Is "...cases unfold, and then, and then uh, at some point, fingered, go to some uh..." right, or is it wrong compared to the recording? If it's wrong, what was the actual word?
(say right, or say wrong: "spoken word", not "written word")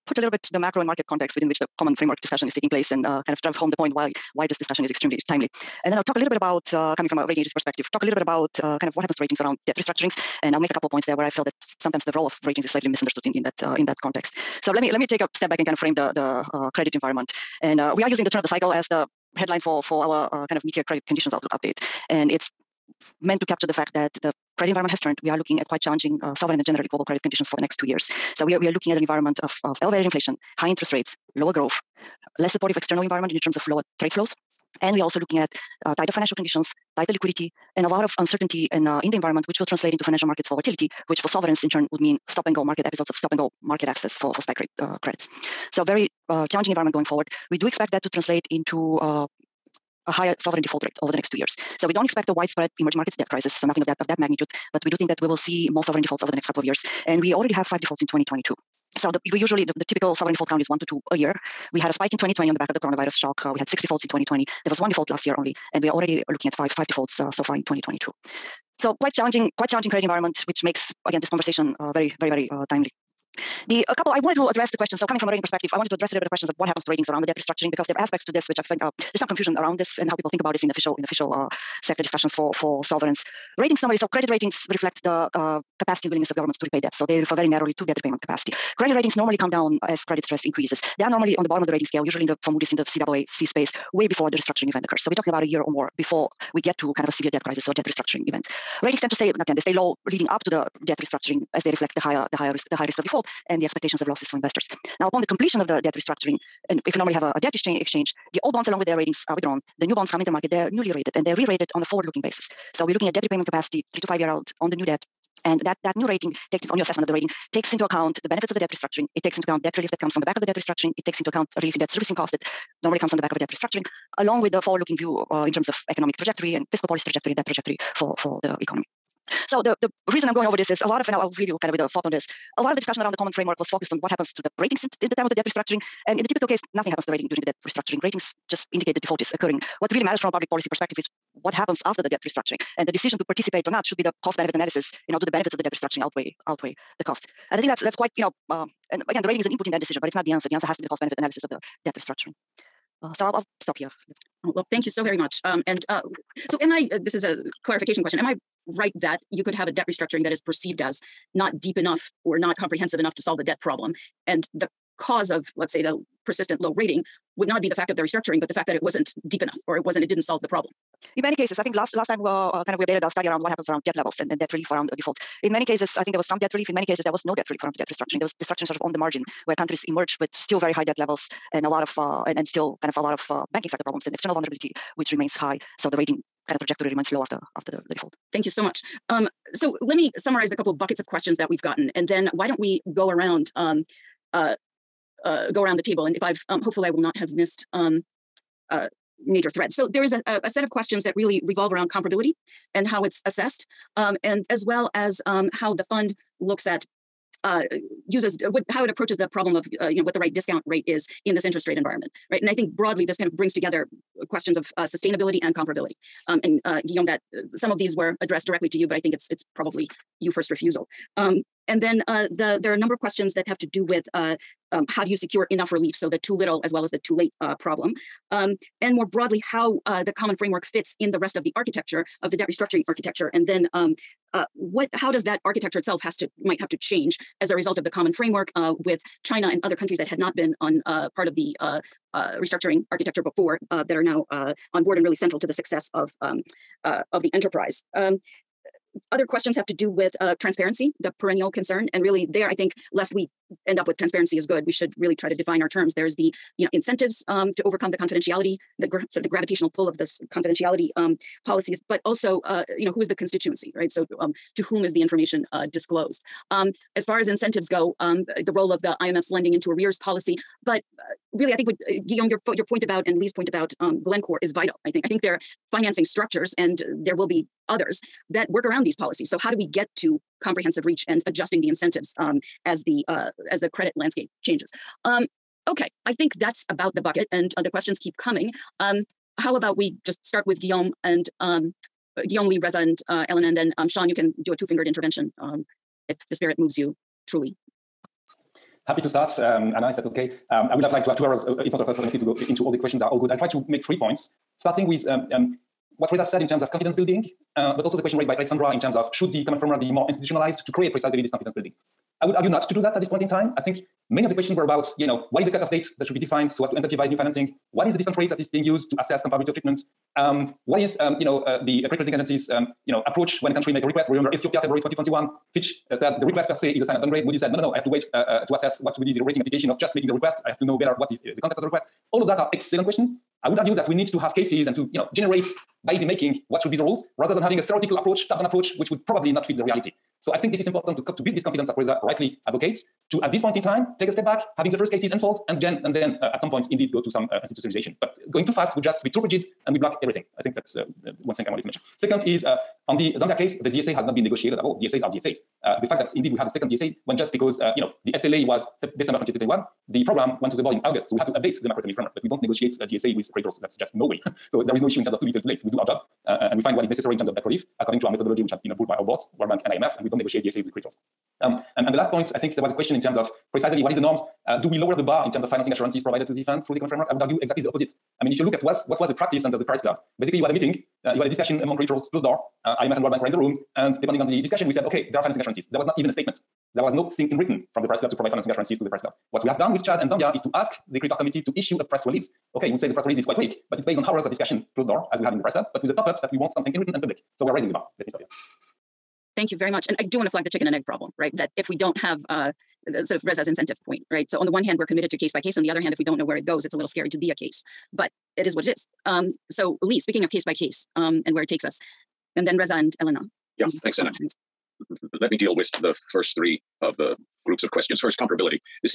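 wrong: "indeed", not "fingered".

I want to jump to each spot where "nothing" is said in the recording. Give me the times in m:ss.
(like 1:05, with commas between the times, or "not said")
0:53, 2:16.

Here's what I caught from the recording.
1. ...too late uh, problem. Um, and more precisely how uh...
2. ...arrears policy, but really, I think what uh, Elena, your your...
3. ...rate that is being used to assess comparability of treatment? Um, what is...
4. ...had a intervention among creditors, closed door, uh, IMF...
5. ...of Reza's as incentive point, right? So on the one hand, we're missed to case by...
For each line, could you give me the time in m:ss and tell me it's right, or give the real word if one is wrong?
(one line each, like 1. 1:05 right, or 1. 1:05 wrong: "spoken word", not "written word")
1. 3:47 wrong: "broadly", not "precisely"
2. 4:29 wrong: "Guillaume", not "Elena"
3. 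5:18 right
4. 6:21 wrong: "discussion", not "intervention"
5. 6:43 wrong: "committed", not "missed".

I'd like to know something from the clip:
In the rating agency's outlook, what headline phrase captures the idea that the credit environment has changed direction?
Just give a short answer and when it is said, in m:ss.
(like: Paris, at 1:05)
The turn of the cycle, at 0:18.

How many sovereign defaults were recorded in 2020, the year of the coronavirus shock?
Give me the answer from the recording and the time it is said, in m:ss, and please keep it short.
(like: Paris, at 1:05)
6, at 1:03.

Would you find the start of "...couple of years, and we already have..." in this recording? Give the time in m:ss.
0:56.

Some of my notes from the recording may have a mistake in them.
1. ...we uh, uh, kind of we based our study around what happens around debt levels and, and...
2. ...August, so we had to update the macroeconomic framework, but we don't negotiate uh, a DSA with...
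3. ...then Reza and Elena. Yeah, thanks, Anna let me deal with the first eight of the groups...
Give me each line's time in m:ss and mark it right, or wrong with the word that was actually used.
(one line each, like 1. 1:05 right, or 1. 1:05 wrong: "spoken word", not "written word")
1. 2:52 wrong: "updated", not "based"
2. 6:00 right
3. 6:52 wrong: "three", not "eight".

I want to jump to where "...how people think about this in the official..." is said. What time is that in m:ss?
1:20.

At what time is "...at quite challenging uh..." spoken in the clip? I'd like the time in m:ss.
0:25.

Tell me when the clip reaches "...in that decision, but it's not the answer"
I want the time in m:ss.
2:29.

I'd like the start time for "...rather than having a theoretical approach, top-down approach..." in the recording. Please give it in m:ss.
5:37.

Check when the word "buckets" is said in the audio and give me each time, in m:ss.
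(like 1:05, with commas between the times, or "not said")
3:10, 4:47.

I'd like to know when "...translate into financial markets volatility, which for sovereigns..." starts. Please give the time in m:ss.
0:39.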